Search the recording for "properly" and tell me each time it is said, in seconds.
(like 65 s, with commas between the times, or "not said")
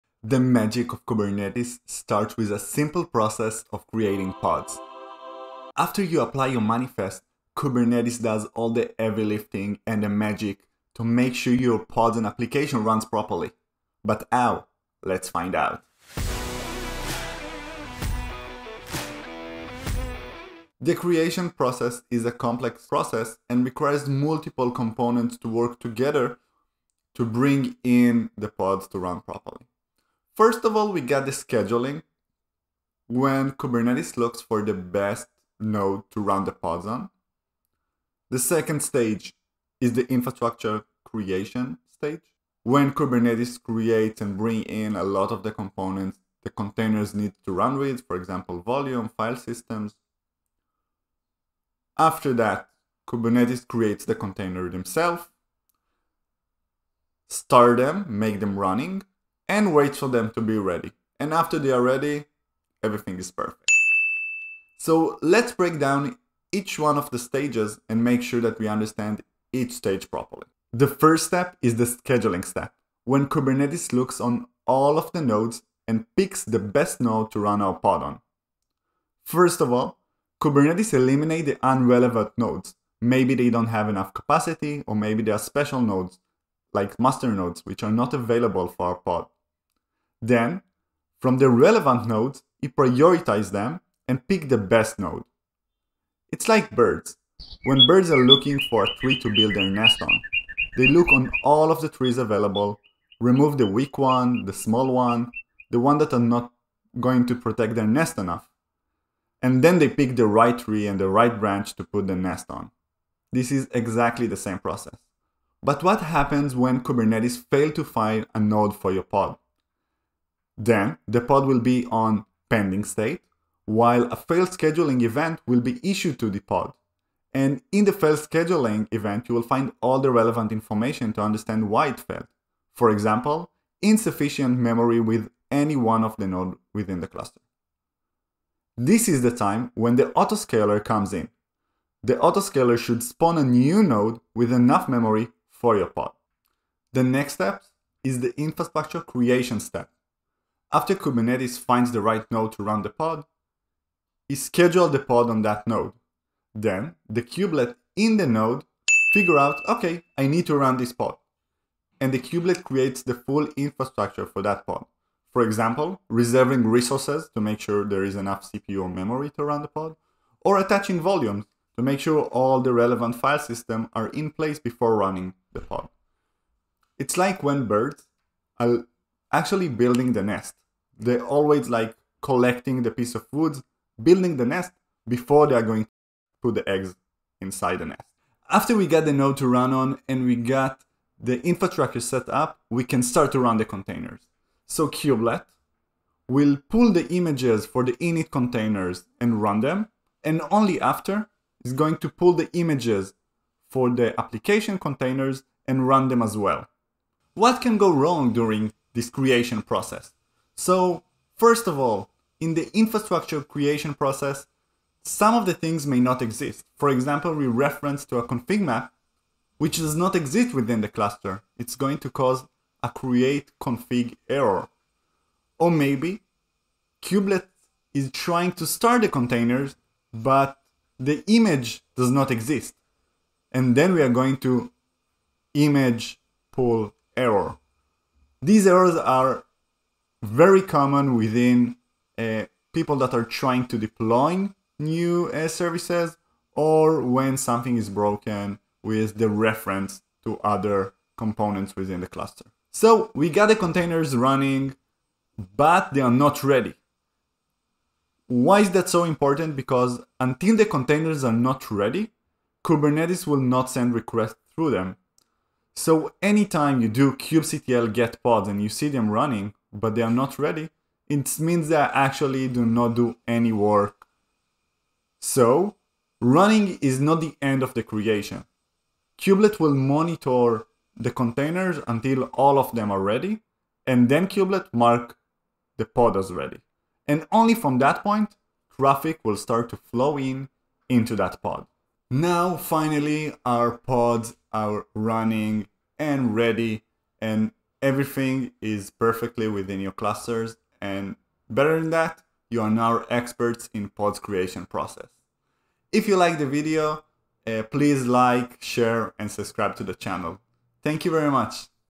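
13 s, 29 s, 70 s.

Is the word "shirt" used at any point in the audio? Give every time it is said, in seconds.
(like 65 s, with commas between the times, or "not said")
not said.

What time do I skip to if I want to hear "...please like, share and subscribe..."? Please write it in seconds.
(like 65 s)
307 s.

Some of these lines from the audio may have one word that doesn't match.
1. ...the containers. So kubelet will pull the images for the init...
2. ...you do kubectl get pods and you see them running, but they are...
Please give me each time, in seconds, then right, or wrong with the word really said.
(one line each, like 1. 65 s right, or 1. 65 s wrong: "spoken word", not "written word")
1. 193 s right
2. 266 s right.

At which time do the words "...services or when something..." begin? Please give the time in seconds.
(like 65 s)
245 s.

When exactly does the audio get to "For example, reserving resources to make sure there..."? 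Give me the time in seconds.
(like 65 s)
165 s.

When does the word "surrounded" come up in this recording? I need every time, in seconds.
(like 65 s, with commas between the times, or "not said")
not said.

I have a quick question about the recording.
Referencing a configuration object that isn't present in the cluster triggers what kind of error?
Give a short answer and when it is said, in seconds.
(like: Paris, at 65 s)
Create config error, at 222 s.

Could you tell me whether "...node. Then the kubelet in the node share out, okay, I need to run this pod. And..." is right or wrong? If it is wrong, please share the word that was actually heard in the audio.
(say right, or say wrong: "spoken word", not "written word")
wrong: "figure", not "share".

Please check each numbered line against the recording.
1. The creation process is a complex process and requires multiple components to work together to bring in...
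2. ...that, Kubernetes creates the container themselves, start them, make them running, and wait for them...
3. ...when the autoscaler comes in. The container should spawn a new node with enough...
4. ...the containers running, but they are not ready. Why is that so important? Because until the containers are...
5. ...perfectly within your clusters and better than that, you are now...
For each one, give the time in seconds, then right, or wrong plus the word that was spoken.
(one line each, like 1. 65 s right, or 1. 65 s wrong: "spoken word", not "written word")
1. 20 s right
2. 52 s right
3. 139 s wrong: "autoscaler", not "container"
4. 253 s right
5. 298 s right.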